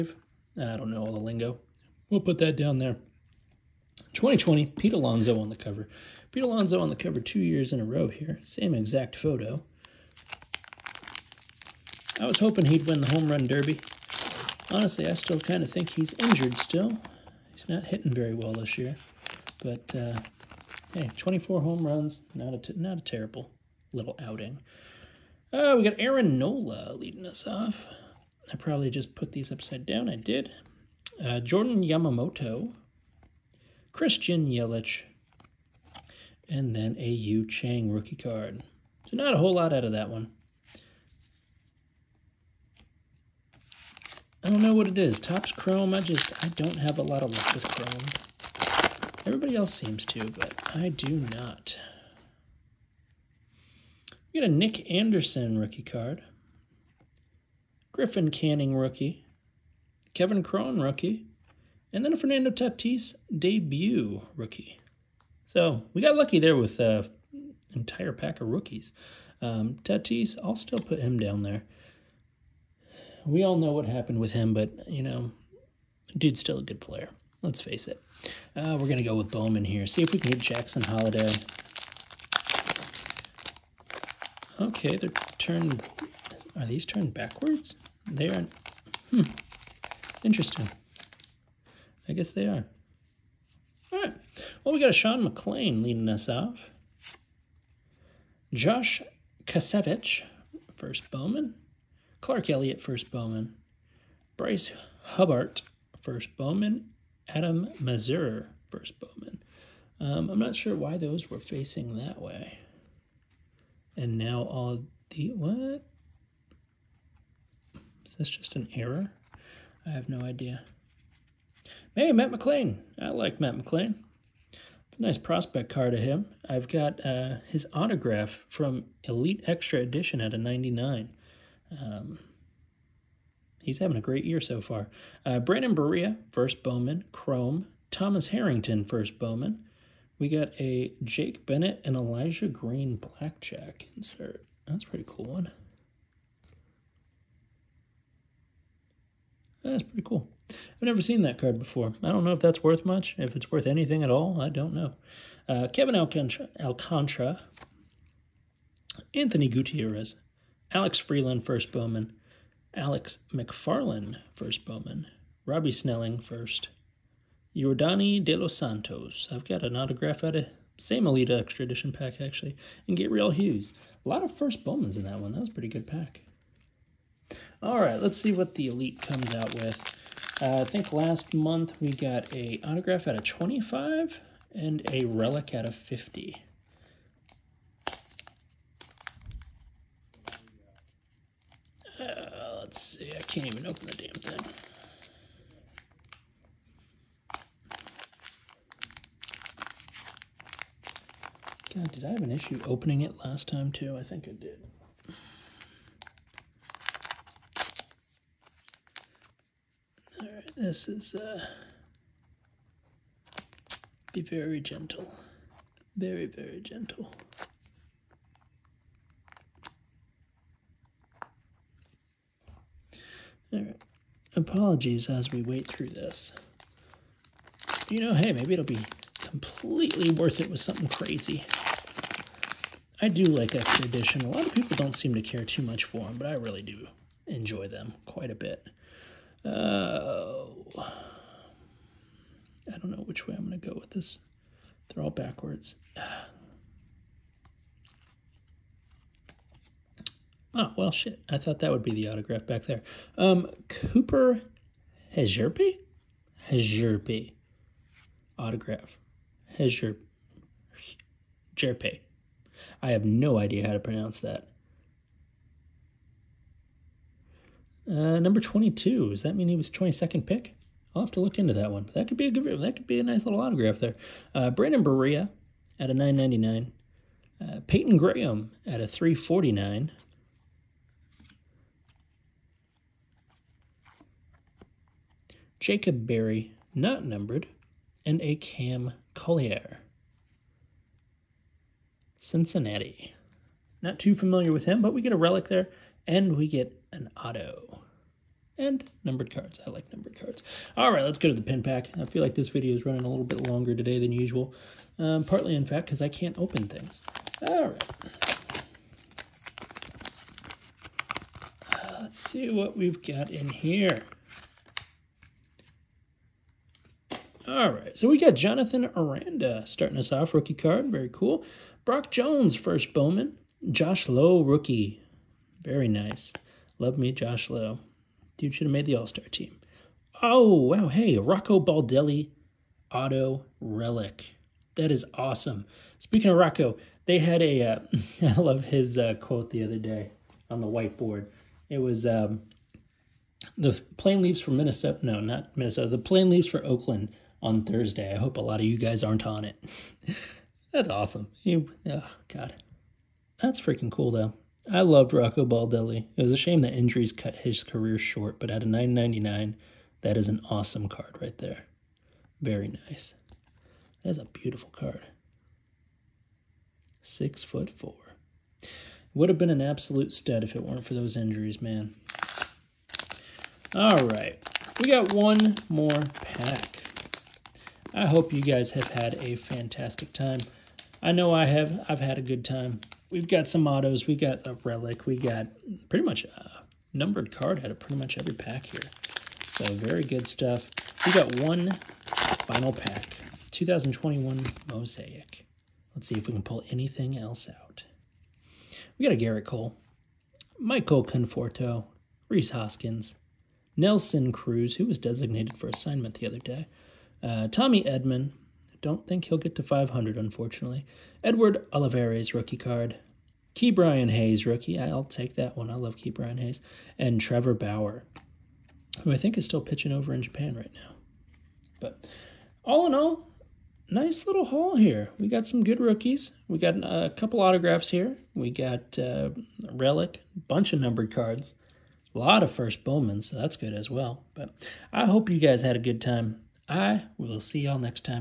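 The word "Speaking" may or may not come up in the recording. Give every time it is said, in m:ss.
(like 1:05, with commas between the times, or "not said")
5:35.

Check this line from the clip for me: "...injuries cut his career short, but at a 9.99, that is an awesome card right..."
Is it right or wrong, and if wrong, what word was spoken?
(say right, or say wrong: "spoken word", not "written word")
right.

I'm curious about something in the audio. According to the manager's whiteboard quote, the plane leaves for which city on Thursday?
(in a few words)
Oakland.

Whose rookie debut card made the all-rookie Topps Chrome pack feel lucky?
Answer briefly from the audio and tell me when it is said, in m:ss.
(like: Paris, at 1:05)
Fernando Tatis, at 1:02.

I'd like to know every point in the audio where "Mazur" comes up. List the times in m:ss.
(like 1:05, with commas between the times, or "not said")
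1:47.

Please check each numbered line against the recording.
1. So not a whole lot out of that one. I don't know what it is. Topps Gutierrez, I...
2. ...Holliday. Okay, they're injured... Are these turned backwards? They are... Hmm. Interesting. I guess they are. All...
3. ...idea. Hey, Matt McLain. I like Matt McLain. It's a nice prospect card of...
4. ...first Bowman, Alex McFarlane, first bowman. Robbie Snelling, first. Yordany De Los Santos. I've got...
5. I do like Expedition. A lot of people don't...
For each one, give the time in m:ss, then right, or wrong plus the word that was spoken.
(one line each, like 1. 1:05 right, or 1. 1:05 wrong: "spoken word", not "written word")
1. 0:39 wrong: "Chrome", not "Gutierrez"
2. 1:20 wrong: "turned", not "injured"
3. 2:00 right
4. 2:41 right
5. 3:52 right.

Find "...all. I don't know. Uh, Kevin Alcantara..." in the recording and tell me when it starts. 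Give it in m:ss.
2:34.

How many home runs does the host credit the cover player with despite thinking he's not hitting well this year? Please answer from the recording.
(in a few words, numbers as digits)
24.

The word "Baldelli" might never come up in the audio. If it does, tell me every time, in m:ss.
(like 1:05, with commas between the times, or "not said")
5:31, 5:55.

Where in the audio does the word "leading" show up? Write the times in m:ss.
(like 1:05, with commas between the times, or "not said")
0:26, 1:35.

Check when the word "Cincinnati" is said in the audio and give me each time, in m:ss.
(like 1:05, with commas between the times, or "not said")
4:52.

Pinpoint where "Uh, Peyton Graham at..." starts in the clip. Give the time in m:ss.
4:37.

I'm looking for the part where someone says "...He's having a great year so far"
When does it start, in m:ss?
2:13.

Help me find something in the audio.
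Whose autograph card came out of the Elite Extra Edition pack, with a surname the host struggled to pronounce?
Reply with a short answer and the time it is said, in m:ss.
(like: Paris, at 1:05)
Cooper Hezerpe, at 4:13.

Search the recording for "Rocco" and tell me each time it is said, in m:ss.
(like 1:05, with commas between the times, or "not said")
5:31, 5:36, 5:55.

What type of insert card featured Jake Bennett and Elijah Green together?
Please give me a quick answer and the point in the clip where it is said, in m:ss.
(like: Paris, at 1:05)
Blackjack insert, at 2:22.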